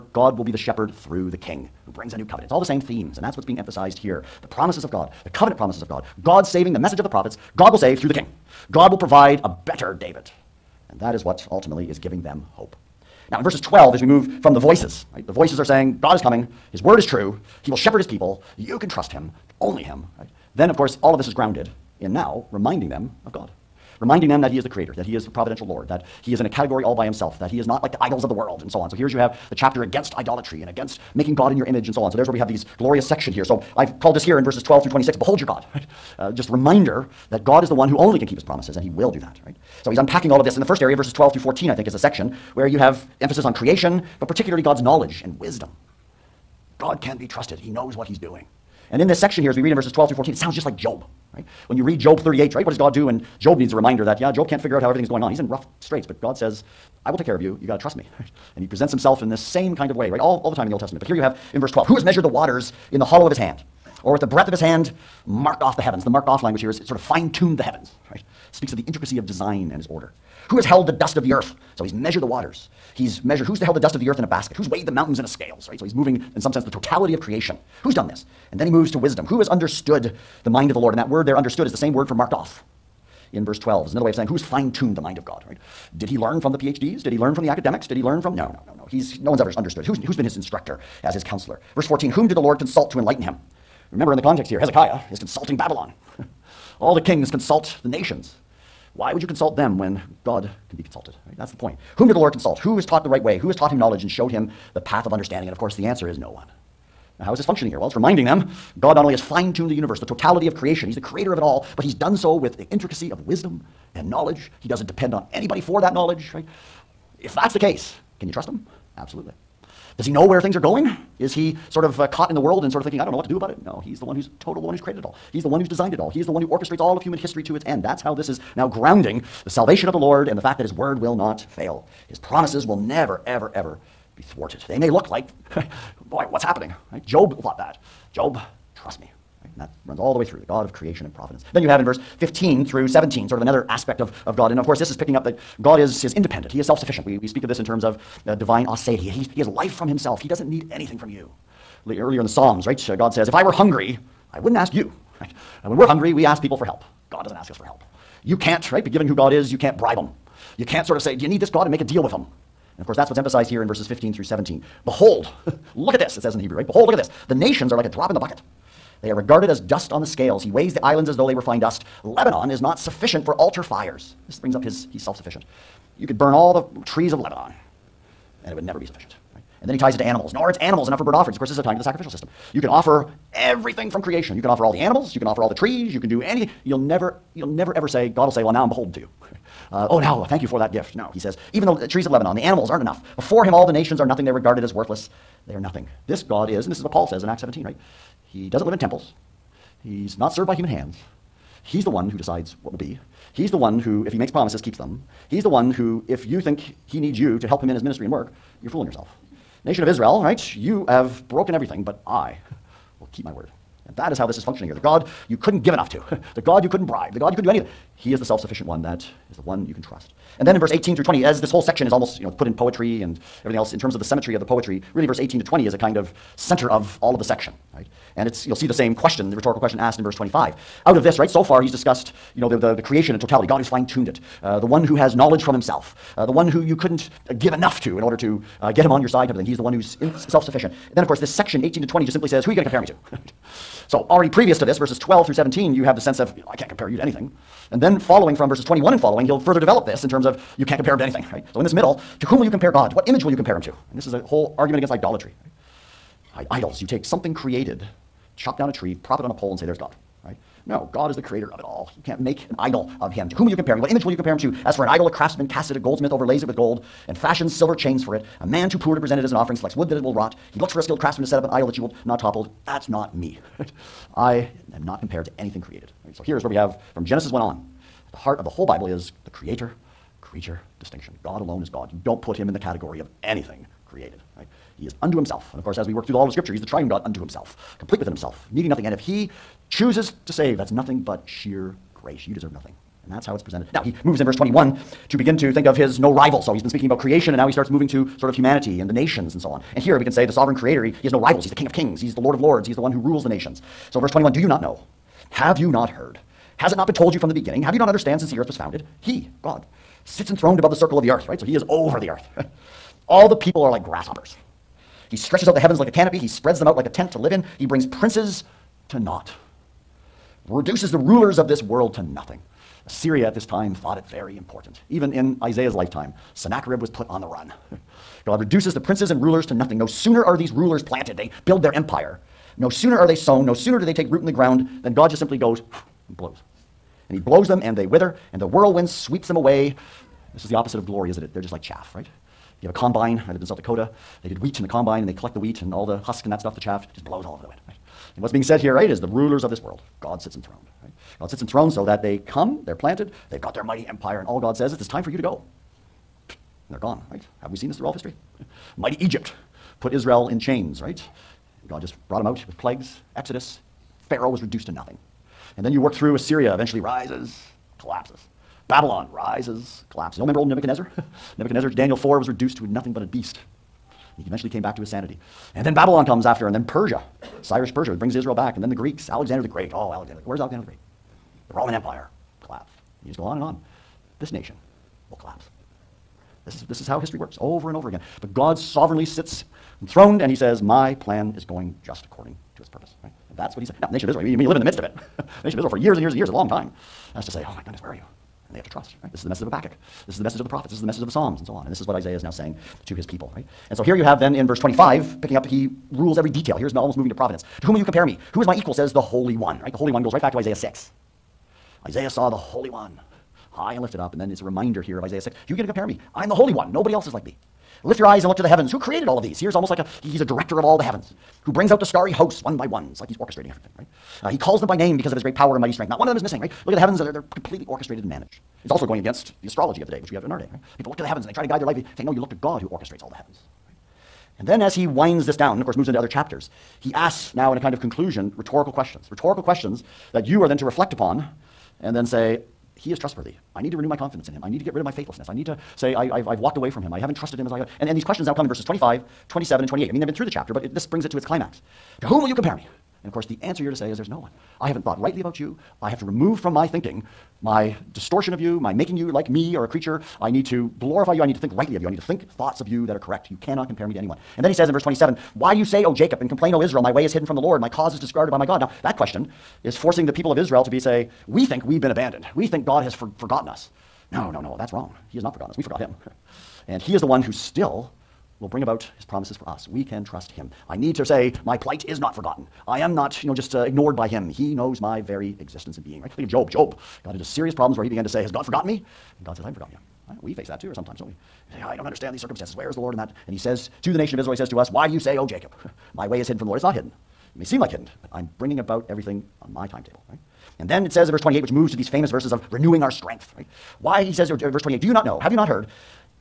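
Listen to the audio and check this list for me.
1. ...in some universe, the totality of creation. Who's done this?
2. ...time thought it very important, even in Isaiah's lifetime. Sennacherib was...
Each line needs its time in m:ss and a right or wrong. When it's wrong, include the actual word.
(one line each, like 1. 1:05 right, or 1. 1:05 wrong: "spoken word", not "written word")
1. 1:16 wrong: "sense", not "universe"
2. 5:23 right.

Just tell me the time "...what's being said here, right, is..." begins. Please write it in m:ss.
5:48.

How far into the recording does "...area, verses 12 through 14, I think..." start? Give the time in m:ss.
0:40.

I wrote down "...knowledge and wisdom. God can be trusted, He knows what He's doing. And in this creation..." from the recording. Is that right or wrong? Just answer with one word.
wrong.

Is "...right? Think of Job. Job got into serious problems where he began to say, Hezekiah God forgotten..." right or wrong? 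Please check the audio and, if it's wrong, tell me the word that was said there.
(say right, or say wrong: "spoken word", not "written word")
wrong: "Has", not "Hezekiah".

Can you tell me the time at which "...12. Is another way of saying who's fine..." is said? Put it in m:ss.
1:23.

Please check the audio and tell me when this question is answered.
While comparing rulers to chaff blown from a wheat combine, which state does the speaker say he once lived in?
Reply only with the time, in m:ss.
5:43.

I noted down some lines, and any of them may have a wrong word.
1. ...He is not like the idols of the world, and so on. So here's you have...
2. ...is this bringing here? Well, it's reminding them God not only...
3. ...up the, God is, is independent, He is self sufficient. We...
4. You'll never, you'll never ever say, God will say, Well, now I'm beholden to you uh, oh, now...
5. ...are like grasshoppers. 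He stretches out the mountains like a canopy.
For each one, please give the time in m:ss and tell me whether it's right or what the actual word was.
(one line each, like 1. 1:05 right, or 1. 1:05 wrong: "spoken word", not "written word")
1. 0:27 right
2. 1:47 wrong: "functioning", not "bringing"
3. 2:25 right
4. 3:06 right
5. 5:13 wrong: "heavens", not "mountains".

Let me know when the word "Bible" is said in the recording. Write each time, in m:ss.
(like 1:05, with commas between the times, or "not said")
4:38.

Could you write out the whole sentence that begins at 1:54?
He doesn't depend on anybody for that knowledge, right?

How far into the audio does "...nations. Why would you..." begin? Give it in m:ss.
1:37.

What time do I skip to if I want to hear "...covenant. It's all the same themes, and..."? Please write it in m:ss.
0:02.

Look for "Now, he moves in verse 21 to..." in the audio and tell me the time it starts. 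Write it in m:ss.
4:53.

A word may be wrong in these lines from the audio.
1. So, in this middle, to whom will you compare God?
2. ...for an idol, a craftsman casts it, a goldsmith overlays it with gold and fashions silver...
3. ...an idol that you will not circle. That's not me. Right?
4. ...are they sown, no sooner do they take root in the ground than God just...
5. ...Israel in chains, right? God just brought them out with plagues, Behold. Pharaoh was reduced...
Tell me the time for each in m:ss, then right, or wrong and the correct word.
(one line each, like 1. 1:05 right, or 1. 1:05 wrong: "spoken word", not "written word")
1. 4:11 right
2. 4:24 right
3. 4:31 wrong: "topple", not "circle"
4. 5:32 right
5. 5:59 wrong: "Exodus", not "Behold".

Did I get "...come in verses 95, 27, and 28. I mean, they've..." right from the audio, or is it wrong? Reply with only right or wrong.
wrong.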